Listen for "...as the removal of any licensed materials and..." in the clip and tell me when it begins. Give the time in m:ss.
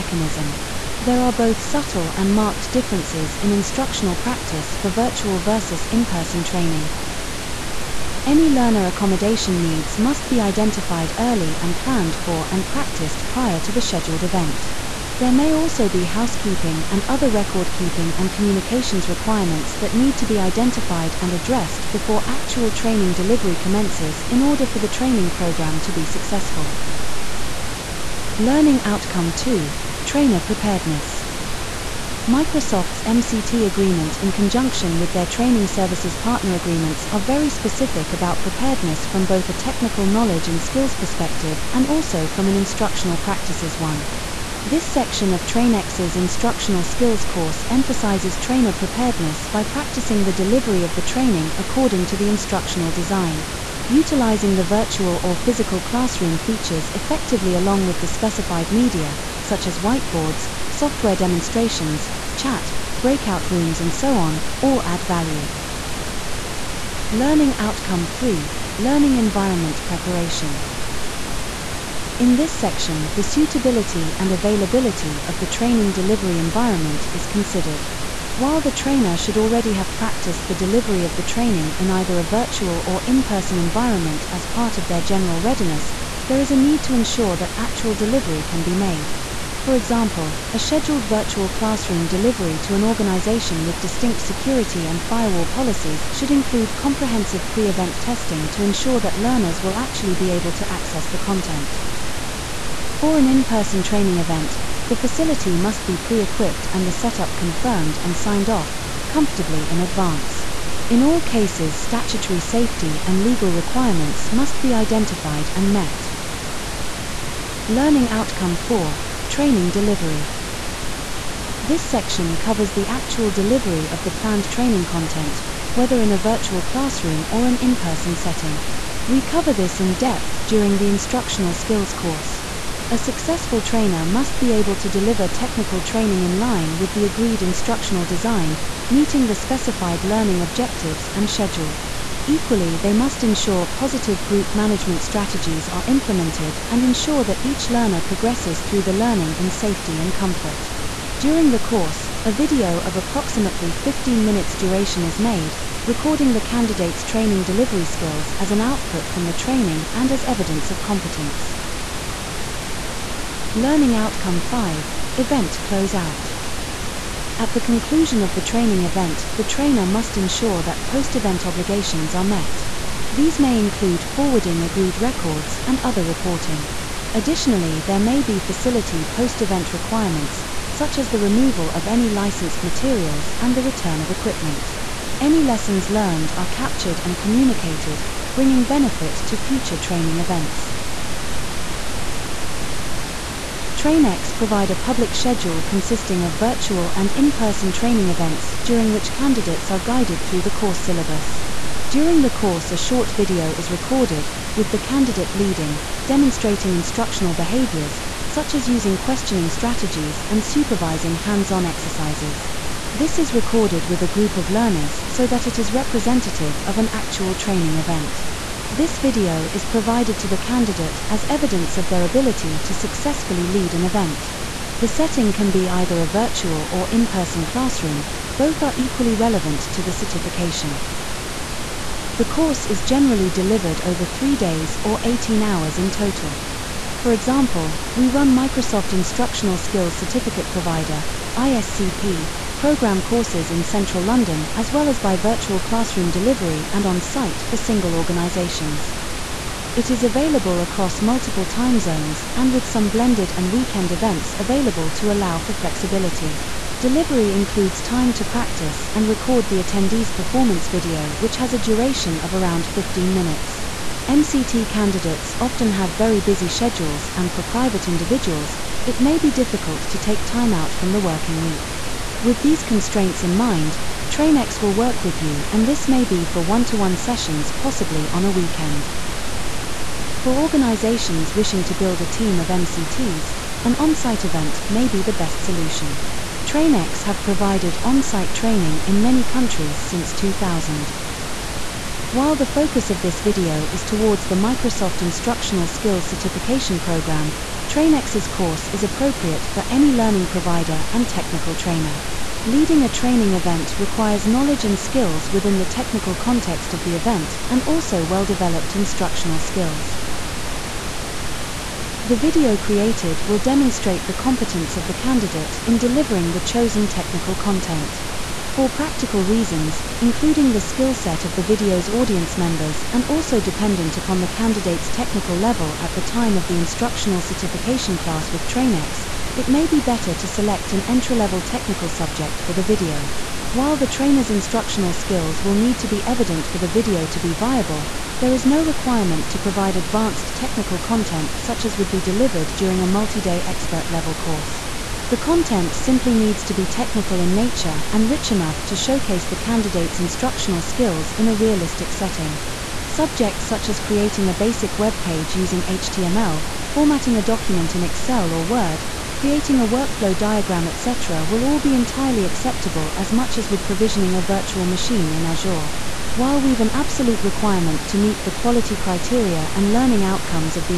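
3:00.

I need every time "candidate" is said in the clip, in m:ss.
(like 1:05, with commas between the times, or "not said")
2:36, 3:19, 3:24, 3:40, 4:24, 5:14, 5:24, 5:49.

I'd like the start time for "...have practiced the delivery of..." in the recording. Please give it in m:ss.
1:19.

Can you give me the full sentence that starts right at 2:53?
These may include forwarding agreed records and other reporting.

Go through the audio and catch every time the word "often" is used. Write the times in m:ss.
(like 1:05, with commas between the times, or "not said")
4:25.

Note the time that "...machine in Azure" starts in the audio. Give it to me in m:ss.
6:04.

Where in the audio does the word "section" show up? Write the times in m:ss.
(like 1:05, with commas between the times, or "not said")
0:44, 1:12, 2:01.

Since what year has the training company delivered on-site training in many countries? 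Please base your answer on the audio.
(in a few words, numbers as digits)
2000.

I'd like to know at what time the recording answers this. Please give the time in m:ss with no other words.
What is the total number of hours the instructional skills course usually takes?
3:55.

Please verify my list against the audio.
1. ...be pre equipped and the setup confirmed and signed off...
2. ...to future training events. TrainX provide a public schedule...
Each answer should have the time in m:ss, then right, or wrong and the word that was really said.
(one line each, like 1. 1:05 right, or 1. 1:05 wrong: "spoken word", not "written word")
1. 1:45 right
2. 3:09 right.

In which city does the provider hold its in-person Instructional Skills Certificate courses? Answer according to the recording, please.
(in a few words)
London.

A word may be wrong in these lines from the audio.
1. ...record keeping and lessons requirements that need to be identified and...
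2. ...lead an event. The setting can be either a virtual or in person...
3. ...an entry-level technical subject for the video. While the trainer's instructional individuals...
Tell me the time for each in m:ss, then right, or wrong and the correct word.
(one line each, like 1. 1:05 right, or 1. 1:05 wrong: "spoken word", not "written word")
1. 0:17 wrong: "communications", not "lessons"
2. 3:43 right
3. 5:30 wrong: "skills", not "individuals".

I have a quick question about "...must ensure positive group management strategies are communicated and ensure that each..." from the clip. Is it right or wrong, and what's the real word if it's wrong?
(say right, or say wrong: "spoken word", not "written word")
wrong: "implemented", not "communicated".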